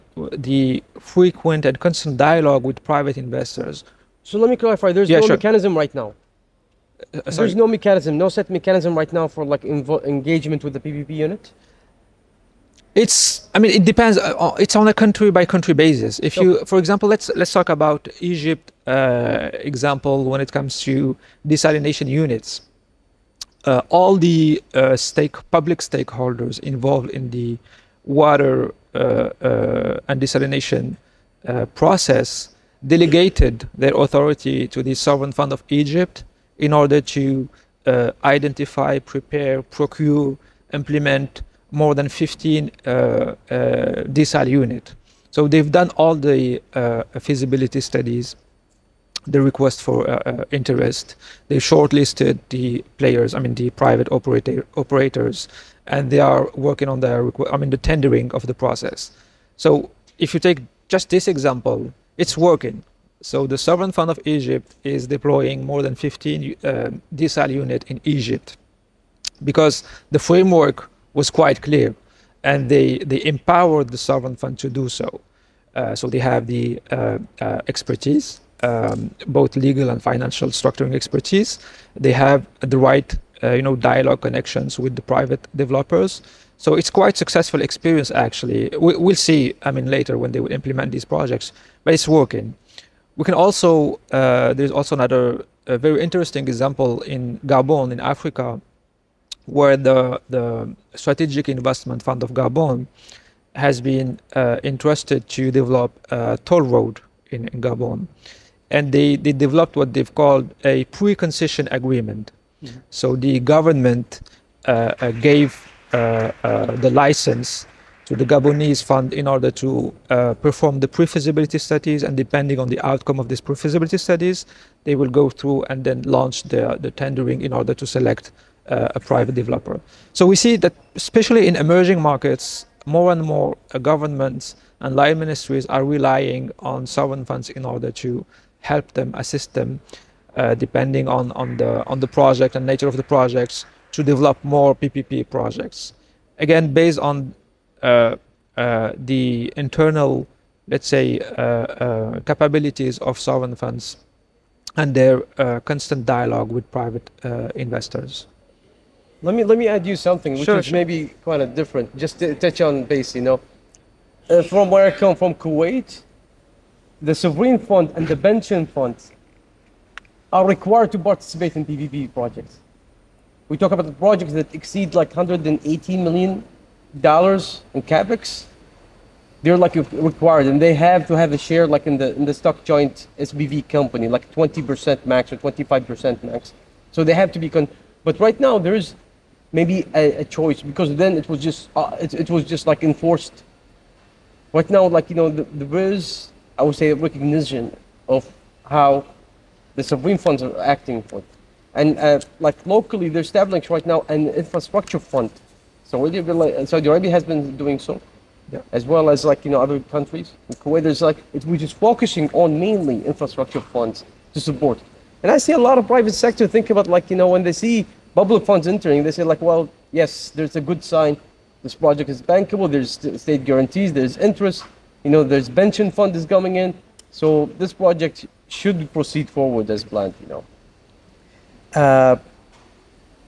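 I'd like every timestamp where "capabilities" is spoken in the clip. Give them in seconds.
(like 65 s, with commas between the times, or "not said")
152 s.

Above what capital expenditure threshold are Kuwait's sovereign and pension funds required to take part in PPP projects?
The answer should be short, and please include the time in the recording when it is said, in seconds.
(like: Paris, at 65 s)
$118 million, at 175 s.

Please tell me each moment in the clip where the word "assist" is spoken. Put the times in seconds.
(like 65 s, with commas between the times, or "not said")
139 s.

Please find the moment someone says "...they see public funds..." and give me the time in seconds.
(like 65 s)
217 s.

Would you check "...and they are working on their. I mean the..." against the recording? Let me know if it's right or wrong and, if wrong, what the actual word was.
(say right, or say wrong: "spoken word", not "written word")
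right.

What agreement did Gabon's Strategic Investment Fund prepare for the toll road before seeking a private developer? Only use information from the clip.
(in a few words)
pre concession agreement.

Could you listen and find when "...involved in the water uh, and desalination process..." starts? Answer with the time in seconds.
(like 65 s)
26 s.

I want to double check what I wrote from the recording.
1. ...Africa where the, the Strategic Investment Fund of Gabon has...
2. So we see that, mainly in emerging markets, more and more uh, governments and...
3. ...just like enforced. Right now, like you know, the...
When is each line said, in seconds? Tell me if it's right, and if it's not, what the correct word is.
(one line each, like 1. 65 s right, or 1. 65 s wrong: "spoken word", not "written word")
1. 97 s right
2. 130 s wrong: "especially", not "mainly"
3. 192 s right.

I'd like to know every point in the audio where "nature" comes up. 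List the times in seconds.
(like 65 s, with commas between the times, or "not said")
142 s.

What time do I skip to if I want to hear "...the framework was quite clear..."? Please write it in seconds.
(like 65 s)
70 s.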